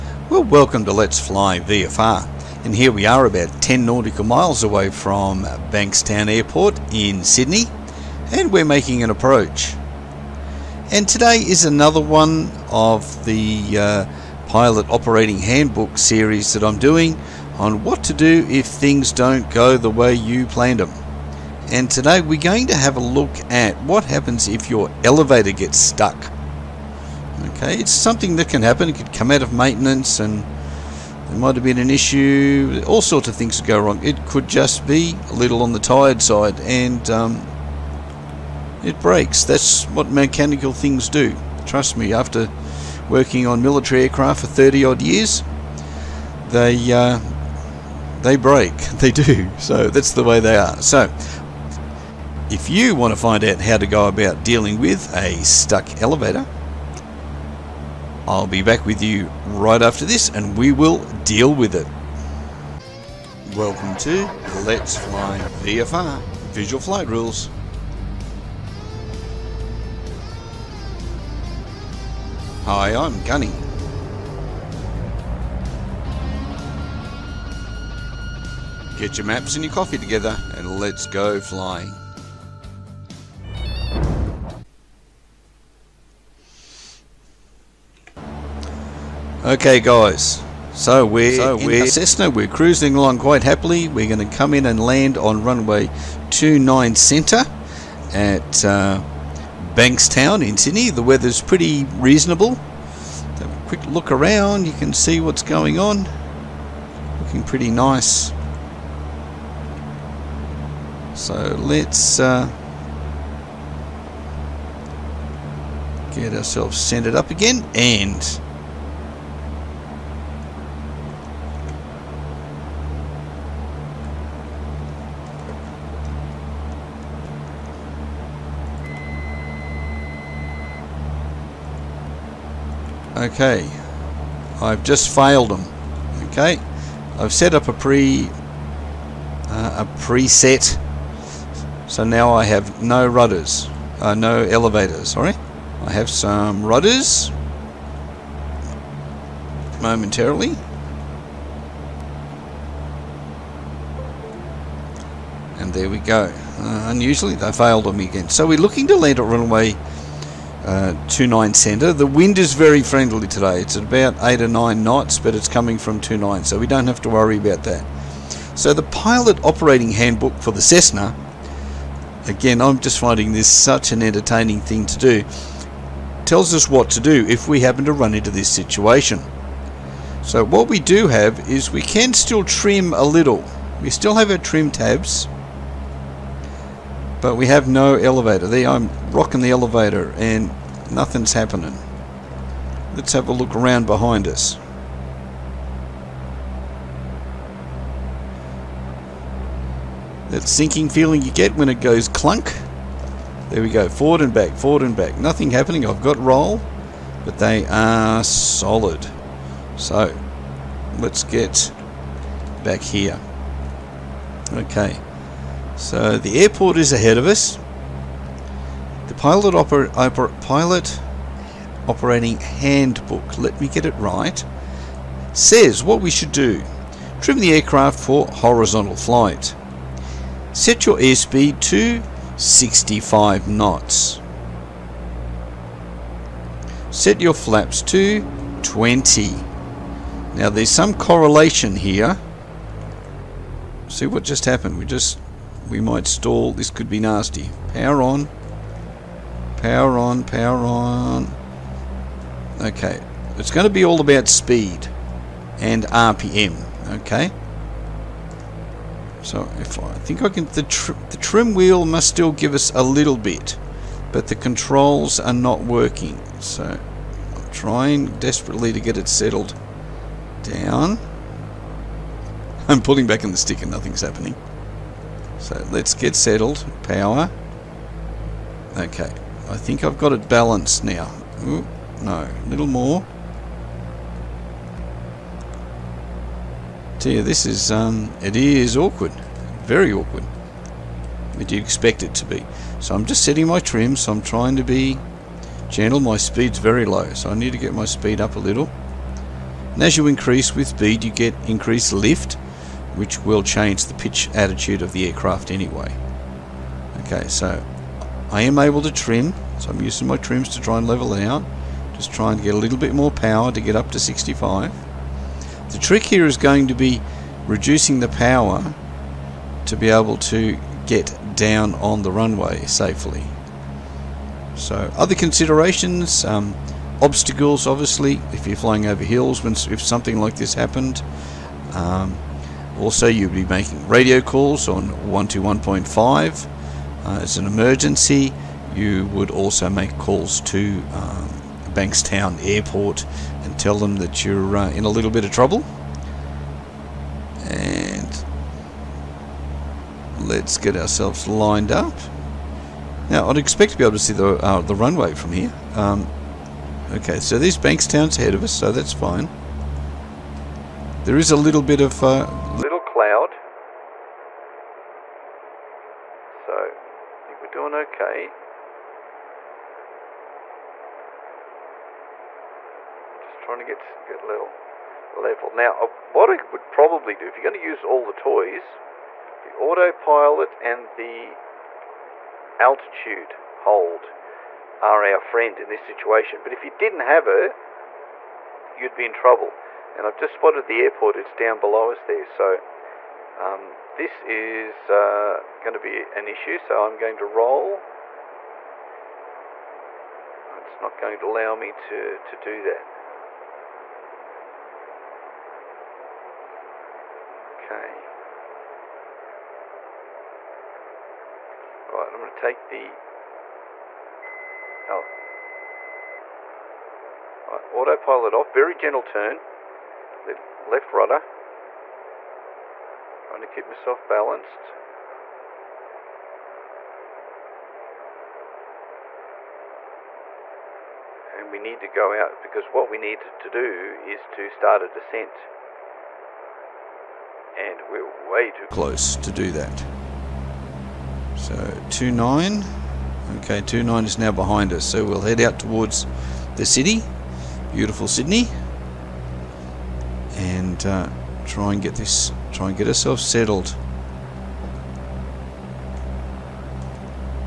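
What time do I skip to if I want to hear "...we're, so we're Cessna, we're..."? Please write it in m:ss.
1:31.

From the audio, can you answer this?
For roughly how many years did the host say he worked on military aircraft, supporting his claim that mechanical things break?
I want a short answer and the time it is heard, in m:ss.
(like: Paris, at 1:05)
30, at 0:44.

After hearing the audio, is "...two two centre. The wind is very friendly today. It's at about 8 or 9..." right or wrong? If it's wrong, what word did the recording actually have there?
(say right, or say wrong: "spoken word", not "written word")
wrong: "nine", not "two".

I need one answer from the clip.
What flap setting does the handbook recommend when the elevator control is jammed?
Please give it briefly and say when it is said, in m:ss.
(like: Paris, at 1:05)
20, at 3:57.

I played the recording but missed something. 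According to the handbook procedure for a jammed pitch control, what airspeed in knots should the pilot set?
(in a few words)
65 knots.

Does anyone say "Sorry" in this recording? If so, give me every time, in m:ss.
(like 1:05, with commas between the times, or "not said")
2:25.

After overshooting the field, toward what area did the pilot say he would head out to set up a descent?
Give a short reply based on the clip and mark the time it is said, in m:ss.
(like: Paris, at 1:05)
the city, at 7:26.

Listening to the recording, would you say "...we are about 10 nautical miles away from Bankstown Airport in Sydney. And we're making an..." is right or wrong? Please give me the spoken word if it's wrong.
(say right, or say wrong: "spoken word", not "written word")
right.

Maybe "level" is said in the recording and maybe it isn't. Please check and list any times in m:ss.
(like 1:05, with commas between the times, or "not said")
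5:10, 6:15.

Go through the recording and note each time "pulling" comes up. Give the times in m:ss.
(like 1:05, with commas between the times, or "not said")
4:32.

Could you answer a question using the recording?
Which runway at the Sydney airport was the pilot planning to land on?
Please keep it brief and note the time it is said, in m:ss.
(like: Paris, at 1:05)
29 centre, at 1:35.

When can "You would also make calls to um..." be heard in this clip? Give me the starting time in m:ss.
5:38.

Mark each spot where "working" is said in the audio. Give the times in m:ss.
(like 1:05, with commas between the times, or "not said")
0:43, 4:25.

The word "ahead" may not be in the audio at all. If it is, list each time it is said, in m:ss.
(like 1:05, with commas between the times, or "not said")
3:36, 5:58.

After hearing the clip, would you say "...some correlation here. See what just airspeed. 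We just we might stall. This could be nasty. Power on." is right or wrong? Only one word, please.
wrong.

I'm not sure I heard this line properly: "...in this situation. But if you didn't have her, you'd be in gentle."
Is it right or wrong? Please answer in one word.
wrong.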